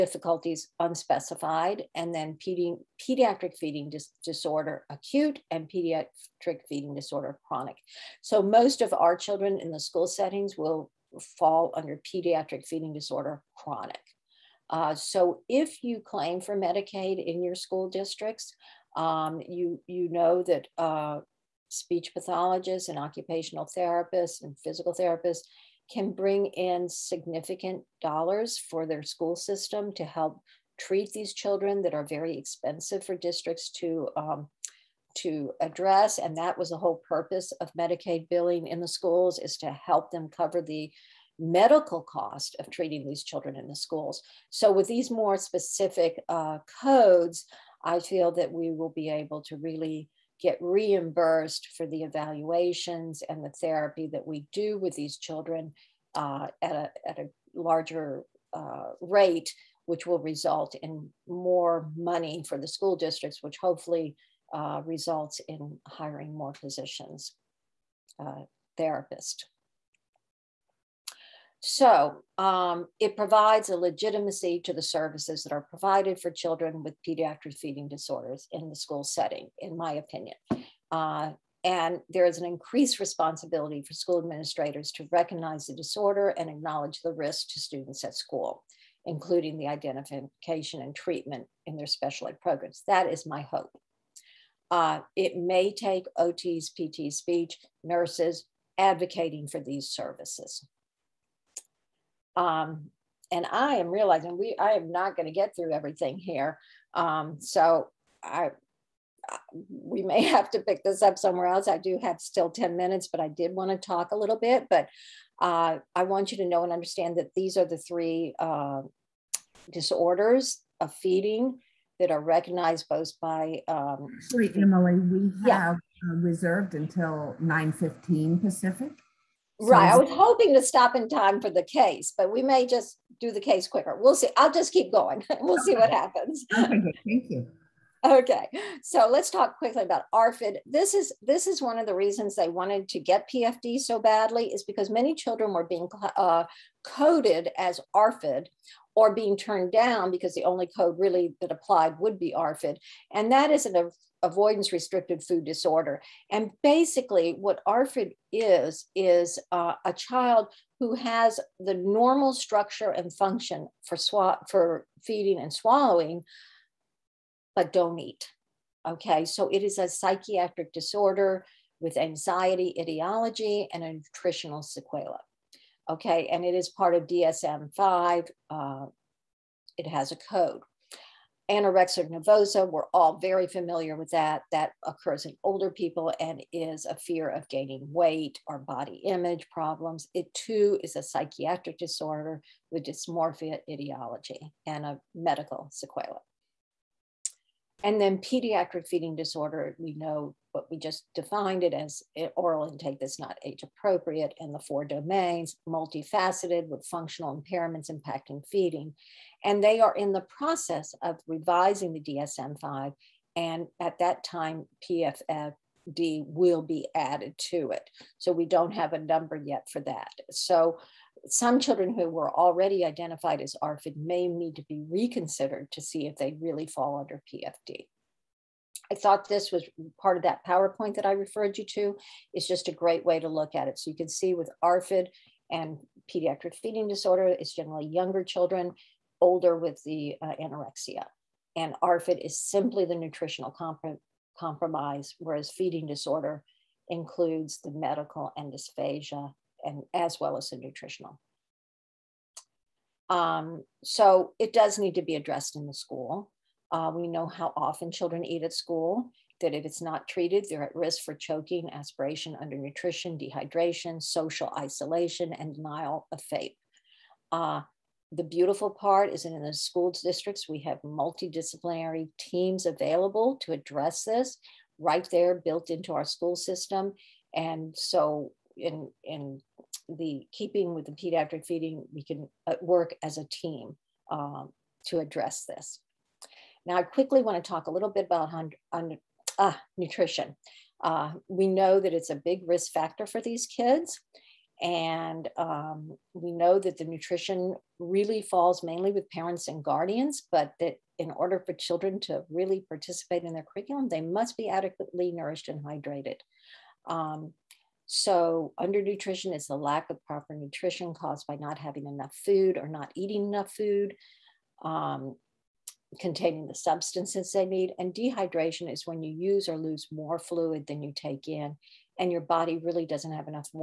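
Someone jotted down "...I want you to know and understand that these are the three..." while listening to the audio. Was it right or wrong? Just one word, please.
right.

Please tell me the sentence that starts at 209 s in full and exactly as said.
And they are in the process of revising the DSM 5.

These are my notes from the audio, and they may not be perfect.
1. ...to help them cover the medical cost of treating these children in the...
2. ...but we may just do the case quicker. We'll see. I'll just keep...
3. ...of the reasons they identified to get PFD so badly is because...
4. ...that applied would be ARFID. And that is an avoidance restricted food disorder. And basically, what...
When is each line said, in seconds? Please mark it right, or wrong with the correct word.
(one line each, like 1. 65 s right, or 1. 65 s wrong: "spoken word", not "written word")
1. 39 s right
2. 132 s right
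3. 141 s wrong: "wanted", not "identified"
4. 151 s right.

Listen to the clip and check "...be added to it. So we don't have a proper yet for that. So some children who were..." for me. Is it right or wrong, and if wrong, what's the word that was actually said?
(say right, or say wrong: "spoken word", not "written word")
wrong: "number", not "proper".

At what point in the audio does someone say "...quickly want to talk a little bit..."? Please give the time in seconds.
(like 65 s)
286 s.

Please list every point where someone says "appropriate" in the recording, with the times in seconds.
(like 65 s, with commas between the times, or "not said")
203 s.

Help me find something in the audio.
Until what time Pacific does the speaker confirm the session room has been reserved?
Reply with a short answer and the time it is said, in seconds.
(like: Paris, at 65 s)
9:15, at 127 s.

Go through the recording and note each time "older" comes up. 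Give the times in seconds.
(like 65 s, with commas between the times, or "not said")
185 s, 239 s.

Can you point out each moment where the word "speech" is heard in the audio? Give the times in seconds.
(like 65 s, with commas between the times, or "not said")
21 s, 97 s.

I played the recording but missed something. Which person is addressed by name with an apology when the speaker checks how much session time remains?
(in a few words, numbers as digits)
Emily.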